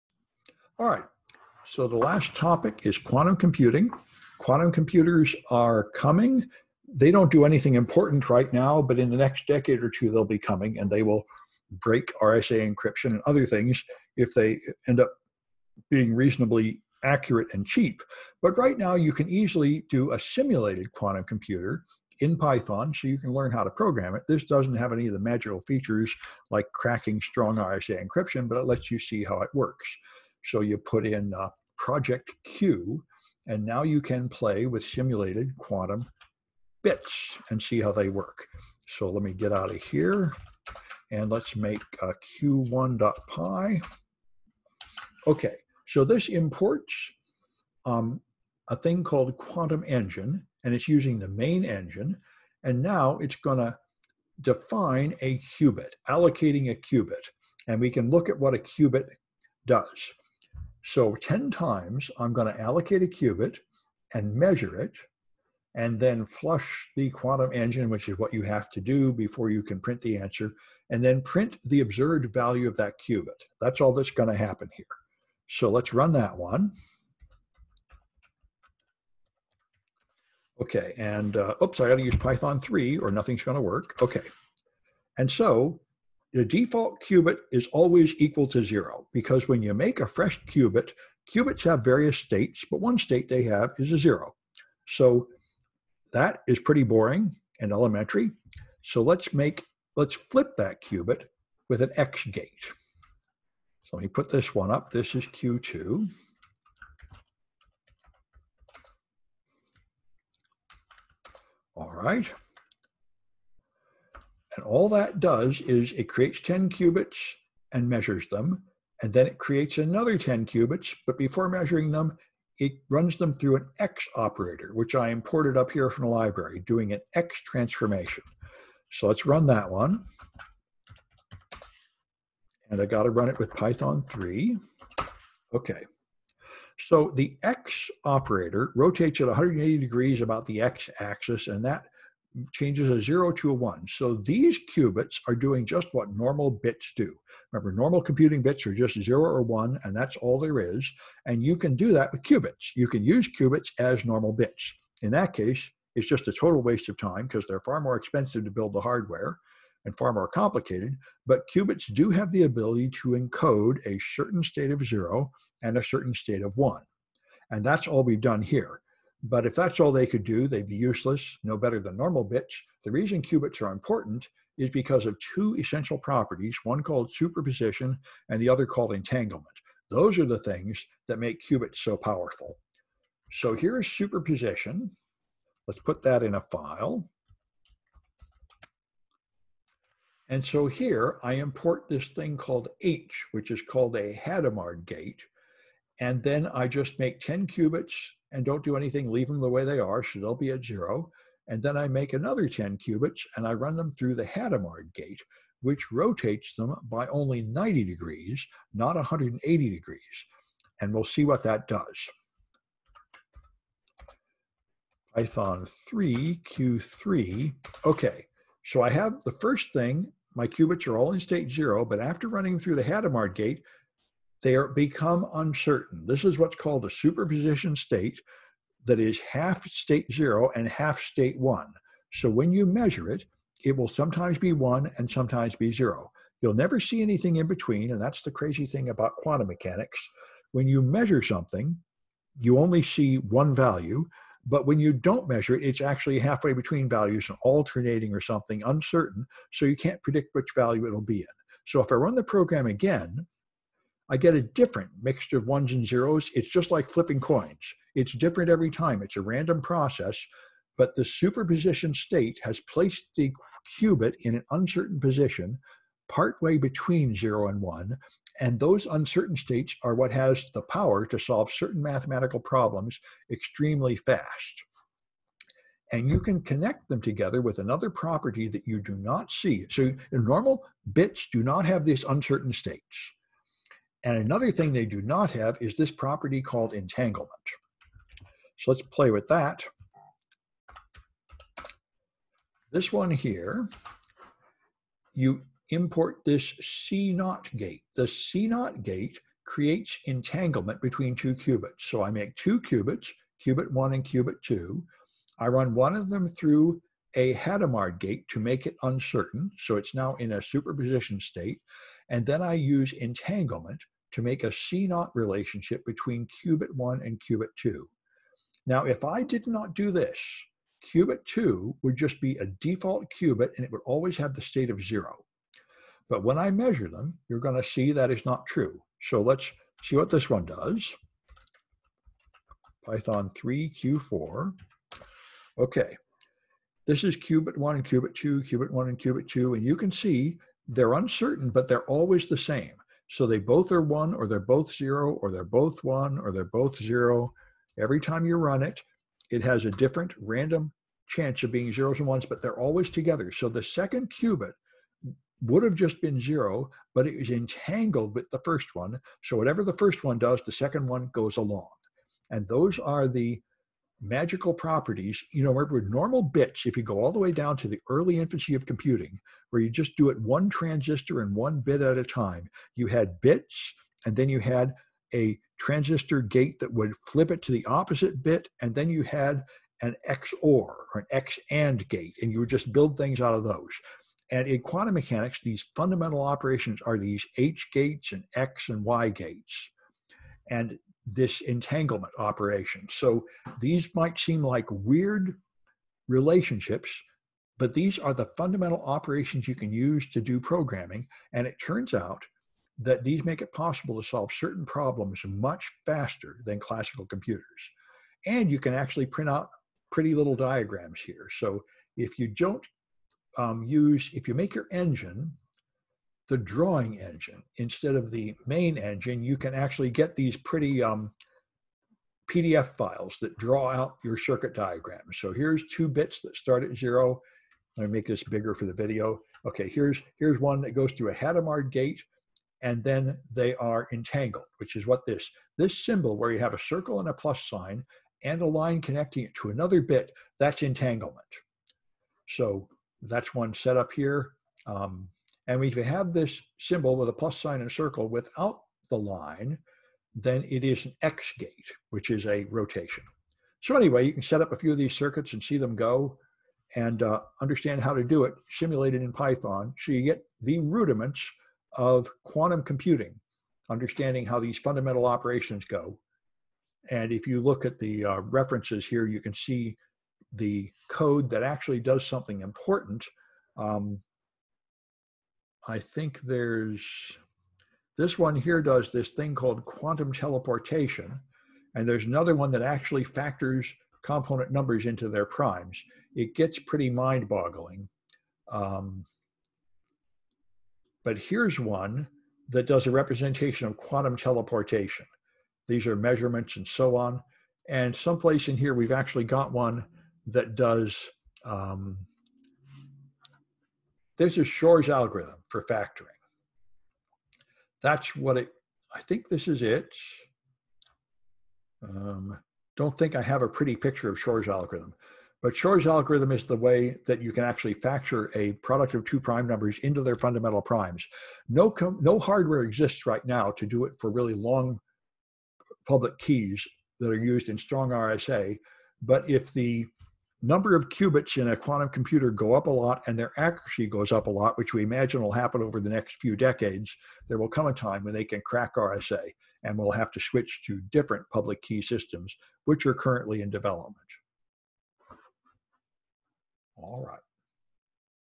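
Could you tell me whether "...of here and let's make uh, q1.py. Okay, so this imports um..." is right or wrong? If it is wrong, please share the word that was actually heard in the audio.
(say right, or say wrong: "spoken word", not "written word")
right.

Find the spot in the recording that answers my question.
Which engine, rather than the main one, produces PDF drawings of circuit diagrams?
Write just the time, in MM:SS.
06:56.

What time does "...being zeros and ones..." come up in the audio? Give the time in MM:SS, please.
05:51.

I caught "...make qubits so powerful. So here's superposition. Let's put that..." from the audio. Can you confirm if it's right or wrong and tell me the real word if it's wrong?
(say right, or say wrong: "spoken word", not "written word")
right.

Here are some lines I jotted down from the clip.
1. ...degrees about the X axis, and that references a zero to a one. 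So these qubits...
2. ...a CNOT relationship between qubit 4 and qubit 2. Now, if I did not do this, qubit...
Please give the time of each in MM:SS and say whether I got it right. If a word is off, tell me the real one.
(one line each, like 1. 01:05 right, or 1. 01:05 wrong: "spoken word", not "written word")
1. 02:19 wrong: "changes", not "references"
2. 05:14 wrong: "1", not "4".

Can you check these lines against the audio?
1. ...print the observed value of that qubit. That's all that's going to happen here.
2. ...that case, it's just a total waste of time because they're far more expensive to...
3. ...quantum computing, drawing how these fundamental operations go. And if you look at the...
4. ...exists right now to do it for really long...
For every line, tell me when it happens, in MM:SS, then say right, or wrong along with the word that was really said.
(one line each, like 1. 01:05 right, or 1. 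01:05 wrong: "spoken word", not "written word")
1. 01:11 right
2. 02:35 right
3. 07:42 wrong: "understanding", not "drawing"
4. 08:42 right.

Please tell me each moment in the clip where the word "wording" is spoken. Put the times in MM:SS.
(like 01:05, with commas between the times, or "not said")
not said.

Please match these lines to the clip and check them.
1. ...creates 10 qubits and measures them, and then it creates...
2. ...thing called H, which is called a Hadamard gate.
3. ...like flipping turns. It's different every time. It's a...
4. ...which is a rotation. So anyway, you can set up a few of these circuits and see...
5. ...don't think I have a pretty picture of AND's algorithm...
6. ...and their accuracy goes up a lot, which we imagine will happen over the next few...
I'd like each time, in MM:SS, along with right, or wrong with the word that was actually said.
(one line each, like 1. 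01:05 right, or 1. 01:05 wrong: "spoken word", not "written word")
1. 01:56 right
2. 03:12 right
3. 04:16 wrong: "coins", not "turns"
4. 07:31 right
5. 08:32 wrong: "Shor", not "AND"
6. 08:53 right.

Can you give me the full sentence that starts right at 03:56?
You'll never see anything in between, and that's the crazy thing about quantum mechanics.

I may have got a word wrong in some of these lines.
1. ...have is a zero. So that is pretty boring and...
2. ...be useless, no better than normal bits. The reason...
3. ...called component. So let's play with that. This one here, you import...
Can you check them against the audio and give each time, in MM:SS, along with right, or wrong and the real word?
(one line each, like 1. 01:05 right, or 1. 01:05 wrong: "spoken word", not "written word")
1. 01:33 right
2. 02:50 right
3. 04:46 wrong: "entanglement", not "component".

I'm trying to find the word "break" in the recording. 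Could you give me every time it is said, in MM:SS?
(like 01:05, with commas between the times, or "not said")
00:11.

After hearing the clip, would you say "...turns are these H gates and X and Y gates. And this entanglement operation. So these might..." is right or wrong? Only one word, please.
wrong.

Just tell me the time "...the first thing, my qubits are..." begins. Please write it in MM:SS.
03:39.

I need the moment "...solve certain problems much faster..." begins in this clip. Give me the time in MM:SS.
06:44.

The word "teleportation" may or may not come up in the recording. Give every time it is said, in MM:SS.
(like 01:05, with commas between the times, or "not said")
08:00, 08:14.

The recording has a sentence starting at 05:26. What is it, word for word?
But when I measure them, you're going to see that is not true.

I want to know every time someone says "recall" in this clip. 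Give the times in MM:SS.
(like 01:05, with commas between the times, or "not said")
not said.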